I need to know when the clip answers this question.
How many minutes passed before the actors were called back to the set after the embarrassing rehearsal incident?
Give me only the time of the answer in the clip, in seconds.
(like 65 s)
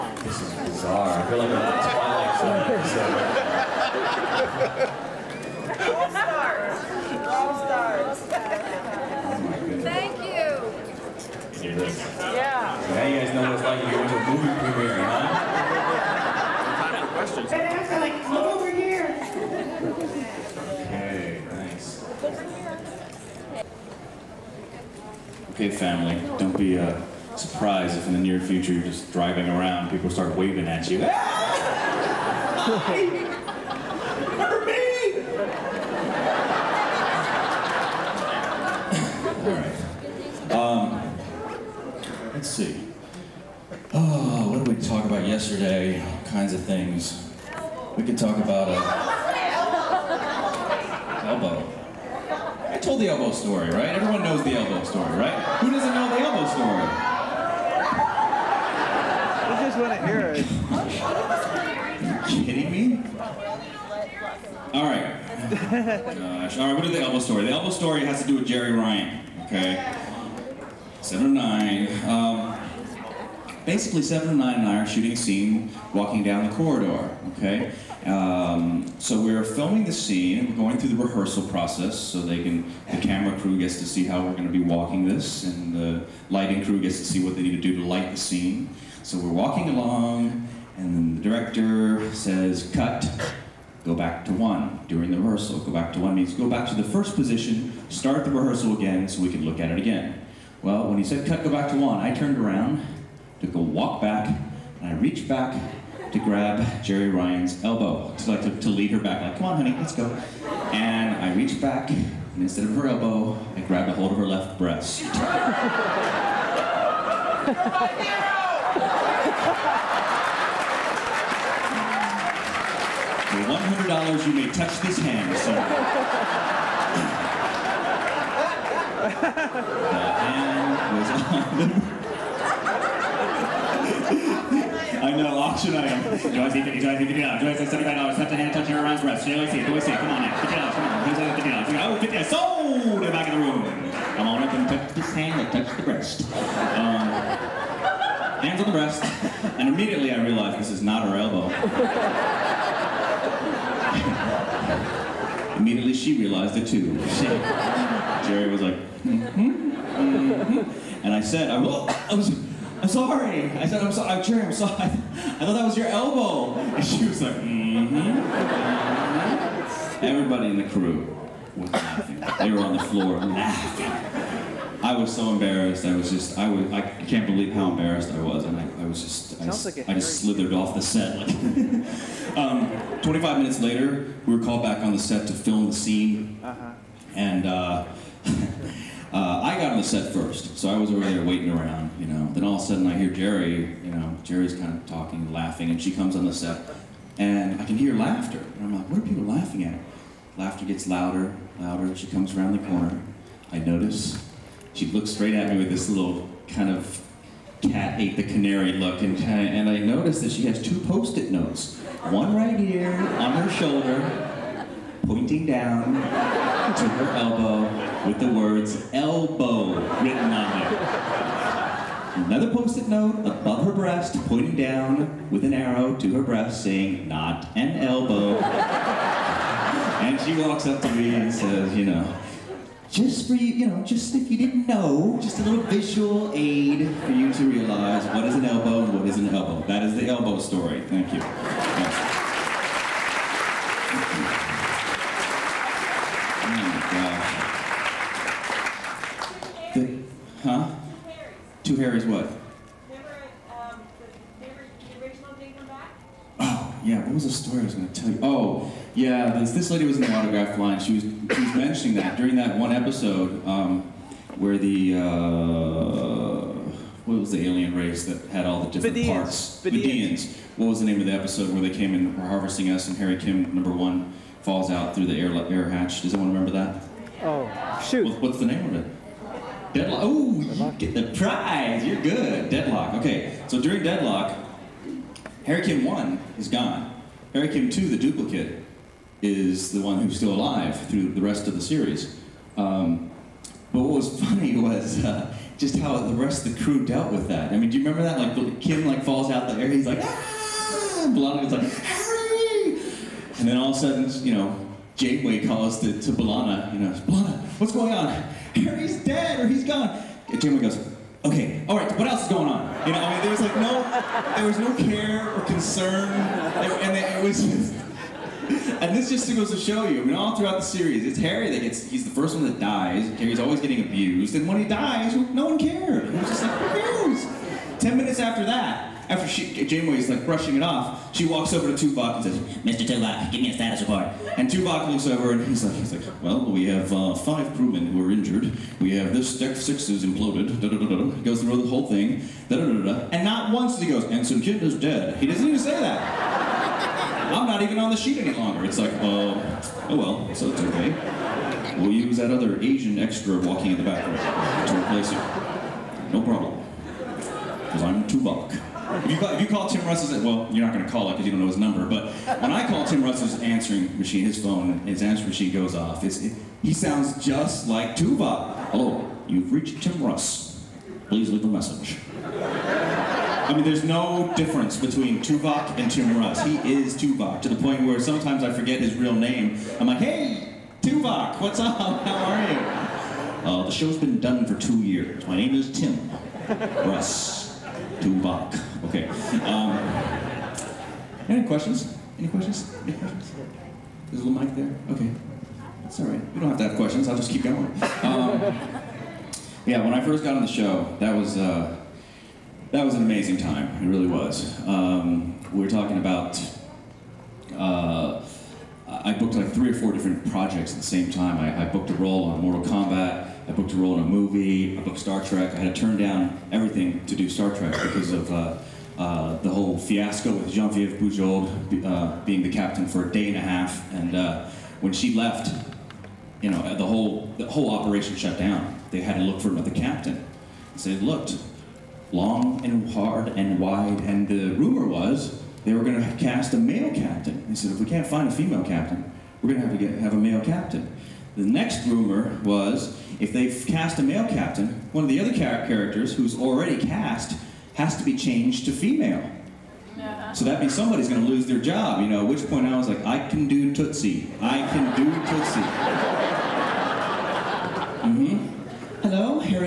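183 s.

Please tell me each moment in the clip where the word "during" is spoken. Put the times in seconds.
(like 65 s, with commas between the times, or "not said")
94 s, 262 s, 283 s.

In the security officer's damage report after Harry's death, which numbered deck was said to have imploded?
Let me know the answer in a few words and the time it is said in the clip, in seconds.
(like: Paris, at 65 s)
Deck six, at 339 s.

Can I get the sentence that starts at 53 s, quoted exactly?
Everyone knows the elbow story, right?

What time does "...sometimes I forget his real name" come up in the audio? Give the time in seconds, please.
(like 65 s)
377 s.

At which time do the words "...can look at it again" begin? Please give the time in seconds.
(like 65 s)
99 s.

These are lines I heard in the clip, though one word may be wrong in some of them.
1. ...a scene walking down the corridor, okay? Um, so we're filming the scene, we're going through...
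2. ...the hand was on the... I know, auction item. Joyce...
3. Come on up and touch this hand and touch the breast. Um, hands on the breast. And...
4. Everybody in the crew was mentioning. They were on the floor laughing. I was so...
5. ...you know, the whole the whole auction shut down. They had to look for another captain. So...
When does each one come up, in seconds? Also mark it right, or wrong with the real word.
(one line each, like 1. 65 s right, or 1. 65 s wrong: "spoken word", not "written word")
1. 75 s right
2. 129 s right
3. 144 s right
4. 170 s wrong: "laughing", not "mentioning"
5. 426 s wrong: "operation", not "auction".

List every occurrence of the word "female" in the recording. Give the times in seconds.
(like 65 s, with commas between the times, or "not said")
438 s, 448 s.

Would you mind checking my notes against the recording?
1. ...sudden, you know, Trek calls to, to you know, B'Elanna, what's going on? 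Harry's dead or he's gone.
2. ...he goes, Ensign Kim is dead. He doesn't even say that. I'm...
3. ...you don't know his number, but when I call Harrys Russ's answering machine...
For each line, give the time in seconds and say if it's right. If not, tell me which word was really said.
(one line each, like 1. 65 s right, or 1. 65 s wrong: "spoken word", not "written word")
1. 303 s wrong: "Janeway", not "Trek"
2. 343 s right
3. 361 s wrong: "Tim", not "Harrys".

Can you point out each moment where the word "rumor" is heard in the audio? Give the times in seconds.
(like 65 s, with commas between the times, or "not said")
434 s, 441 s.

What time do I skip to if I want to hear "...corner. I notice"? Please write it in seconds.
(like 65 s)
202 s.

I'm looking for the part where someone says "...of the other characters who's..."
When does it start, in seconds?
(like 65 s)
445 s.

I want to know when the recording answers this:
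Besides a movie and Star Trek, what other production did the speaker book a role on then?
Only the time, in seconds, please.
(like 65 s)
412 s.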